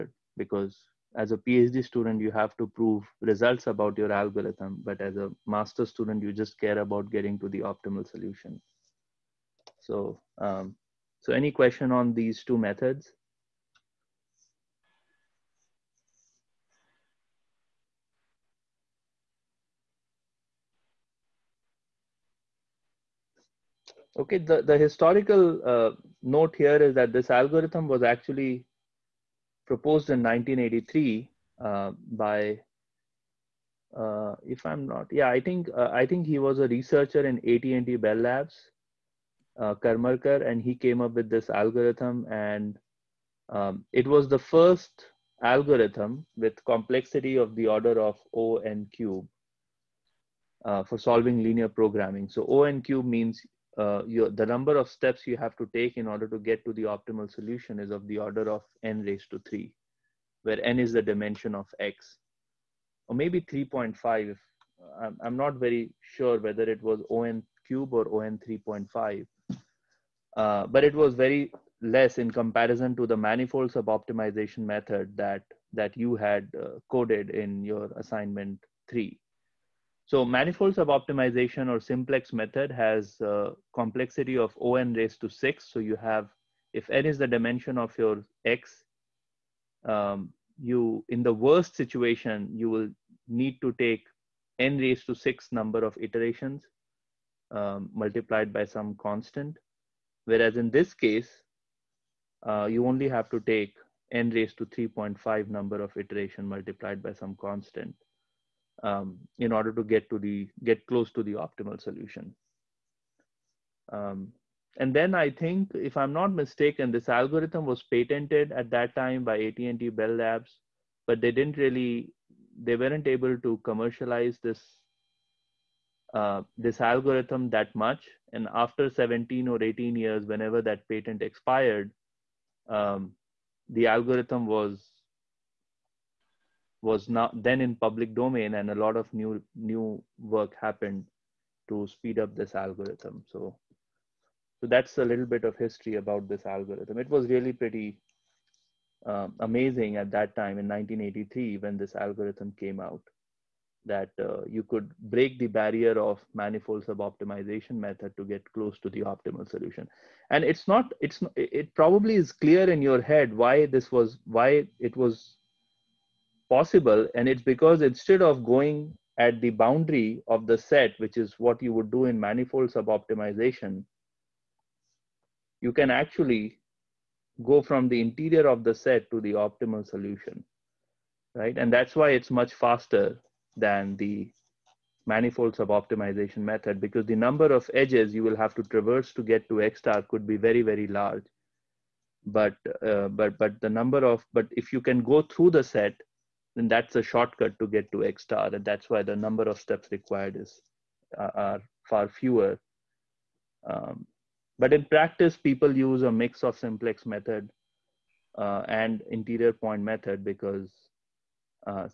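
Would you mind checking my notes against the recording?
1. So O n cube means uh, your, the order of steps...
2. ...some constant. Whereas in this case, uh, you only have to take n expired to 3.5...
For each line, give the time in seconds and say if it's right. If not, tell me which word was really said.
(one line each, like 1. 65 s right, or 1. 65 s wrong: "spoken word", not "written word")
1. 52 s wrong: "number", not "order"
2. 98 s wrong: "raised", not "expired".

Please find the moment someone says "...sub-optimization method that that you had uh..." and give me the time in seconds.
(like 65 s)
73 s.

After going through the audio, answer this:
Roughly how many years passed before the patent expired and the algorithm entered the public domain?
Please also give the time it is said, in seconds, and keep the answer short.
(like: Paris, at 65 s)
17 or 18, at 128 s.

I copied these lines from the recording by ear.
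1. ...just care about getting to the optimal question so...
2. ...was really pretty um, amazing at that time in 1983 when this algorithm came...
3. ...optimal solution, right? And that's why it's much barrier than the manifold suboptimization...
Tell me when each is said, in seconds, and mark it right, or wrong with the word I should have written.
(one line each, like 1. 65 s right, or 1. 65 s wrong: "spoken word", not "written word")
1. 6 s wrong: "solution", not "question"
2. 147 s right
3. 179 s wrong: "faster", not "barrier".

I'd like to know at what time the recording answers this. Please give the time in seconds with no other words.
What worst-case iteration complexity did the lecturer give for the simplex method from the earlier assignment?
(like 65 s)
84 s.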